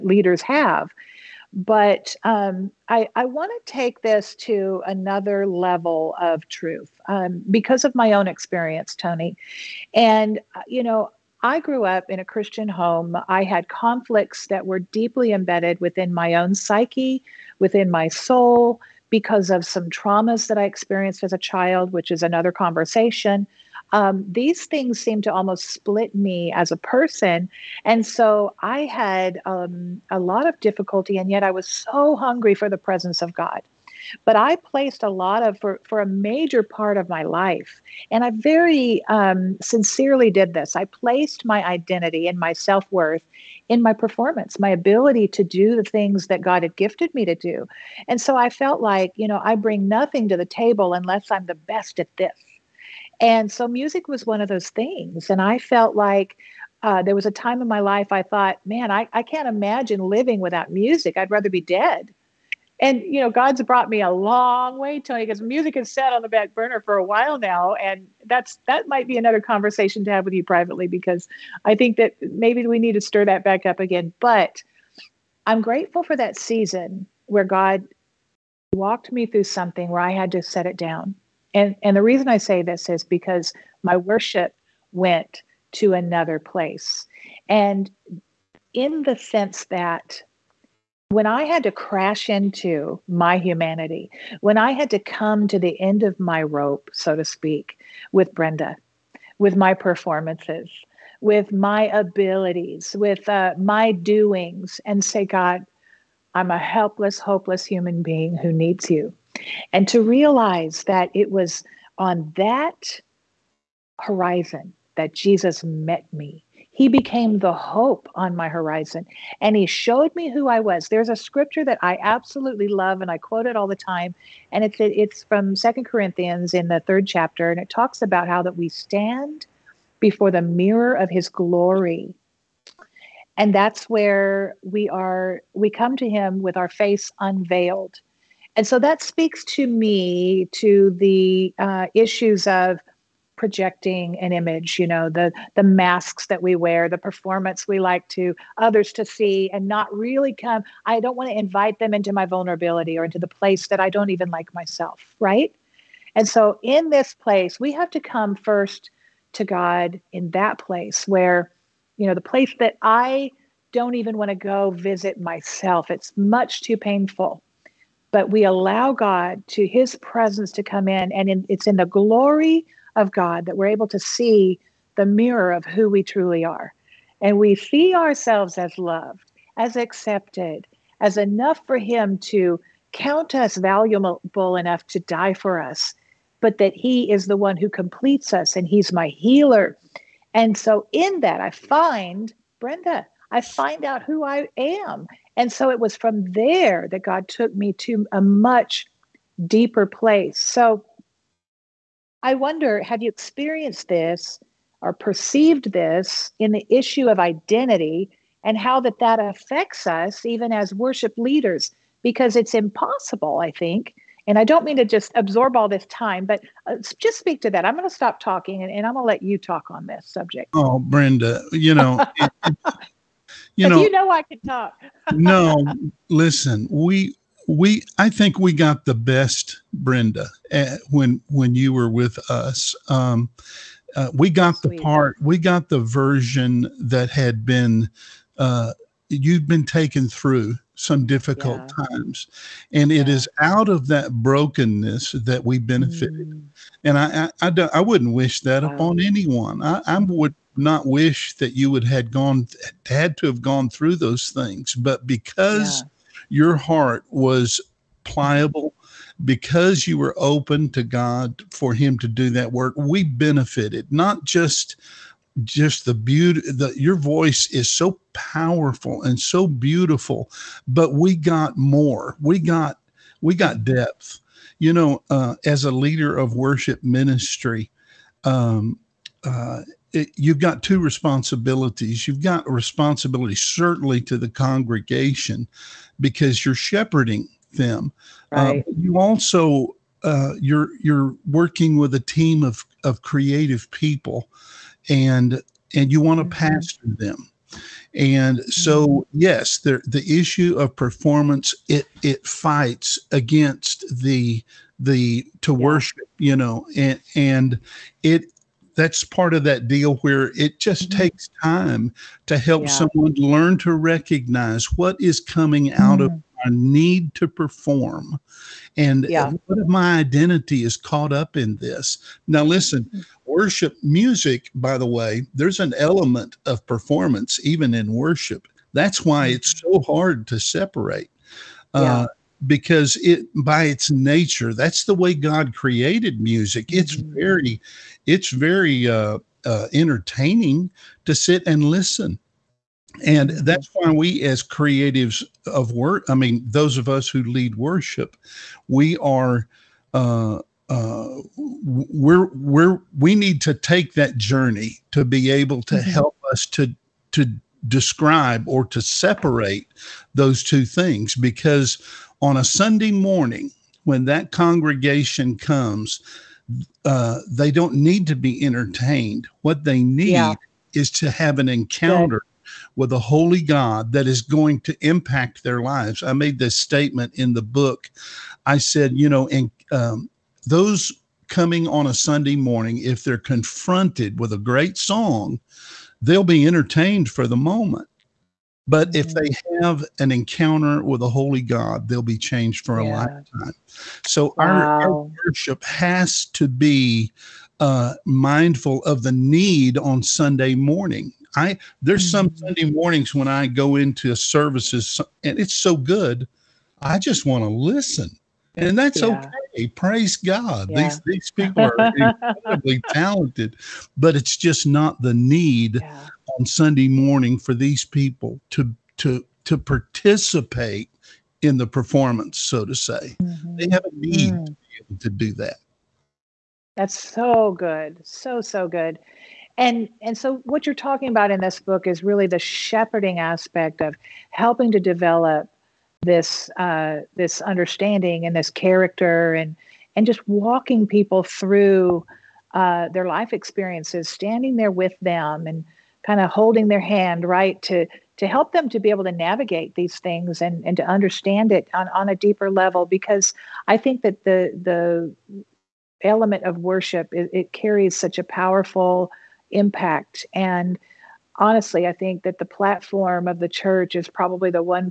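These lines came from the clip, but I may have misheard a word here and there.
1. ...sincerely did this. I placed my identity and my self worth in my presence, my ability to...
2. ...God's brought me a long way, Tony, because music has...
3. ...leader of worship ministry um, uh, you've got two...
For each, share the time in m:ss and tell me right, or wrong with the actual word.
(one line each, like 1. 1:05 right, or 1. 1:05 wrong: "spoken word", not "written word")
1. 0:39 wrong: "performance", not "presence"
2. 1:03 right
3. 4:35 right.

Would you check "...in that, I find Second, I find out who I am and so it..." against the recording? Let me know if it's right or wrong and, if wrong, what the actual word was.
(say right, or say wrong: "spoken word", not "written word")
wrong: "Brenda", not "Second".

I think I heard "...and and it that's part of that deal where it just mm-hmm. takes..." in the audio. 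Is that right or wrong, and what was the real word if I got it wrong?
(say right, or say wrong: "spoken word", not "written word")
right.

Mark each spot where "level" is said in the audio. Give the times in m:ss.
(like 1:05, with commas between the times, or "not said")
0:05, 7:32.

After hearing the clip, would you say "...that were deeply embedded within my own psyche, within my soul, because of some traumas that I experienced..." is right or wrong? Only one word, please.
right.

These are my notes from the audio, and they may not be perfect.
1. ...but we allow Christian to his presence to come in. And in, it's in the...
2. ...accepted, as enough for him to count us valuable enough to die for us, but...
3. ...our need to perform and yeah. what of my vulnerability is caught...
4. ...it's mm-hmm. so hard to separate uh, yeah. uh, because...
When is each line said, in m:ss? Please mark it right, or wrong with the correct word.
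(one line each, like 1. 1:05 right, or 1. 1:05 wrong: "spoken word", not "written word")
1. 2:48 wrong: "God", not "Christian"
2. 2:59 right
3. 5:16 wrong: "identity", not "vulnerability"
4. 5:29 right.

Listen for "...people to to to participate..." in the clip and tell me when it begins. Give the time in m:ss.
6:57.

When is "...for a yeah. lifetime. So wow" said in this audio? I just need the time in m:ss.
6:32.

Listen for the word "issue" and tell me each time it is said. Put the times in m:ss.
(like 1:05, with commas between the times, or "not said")
2:21, 3:26, 5:00.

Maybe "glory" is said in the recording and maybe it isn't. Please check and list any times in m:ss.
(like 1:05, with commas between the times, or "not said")
2:11, 2:51.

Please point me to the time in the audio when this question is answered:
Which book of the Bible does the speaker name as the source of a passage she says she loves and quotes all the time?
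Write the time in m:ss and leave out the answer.
2:05.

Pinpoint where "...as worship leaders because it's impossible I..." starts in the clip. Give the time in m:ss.
3:30.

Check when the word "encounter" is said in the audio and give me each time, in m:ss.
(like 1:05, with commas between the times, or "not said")
6:11, 6:30.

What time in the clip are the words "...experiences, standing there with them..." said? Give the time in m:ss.
7:23.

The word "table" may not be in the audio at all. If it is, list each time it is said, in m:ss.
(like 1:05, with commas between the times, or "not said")
0:50.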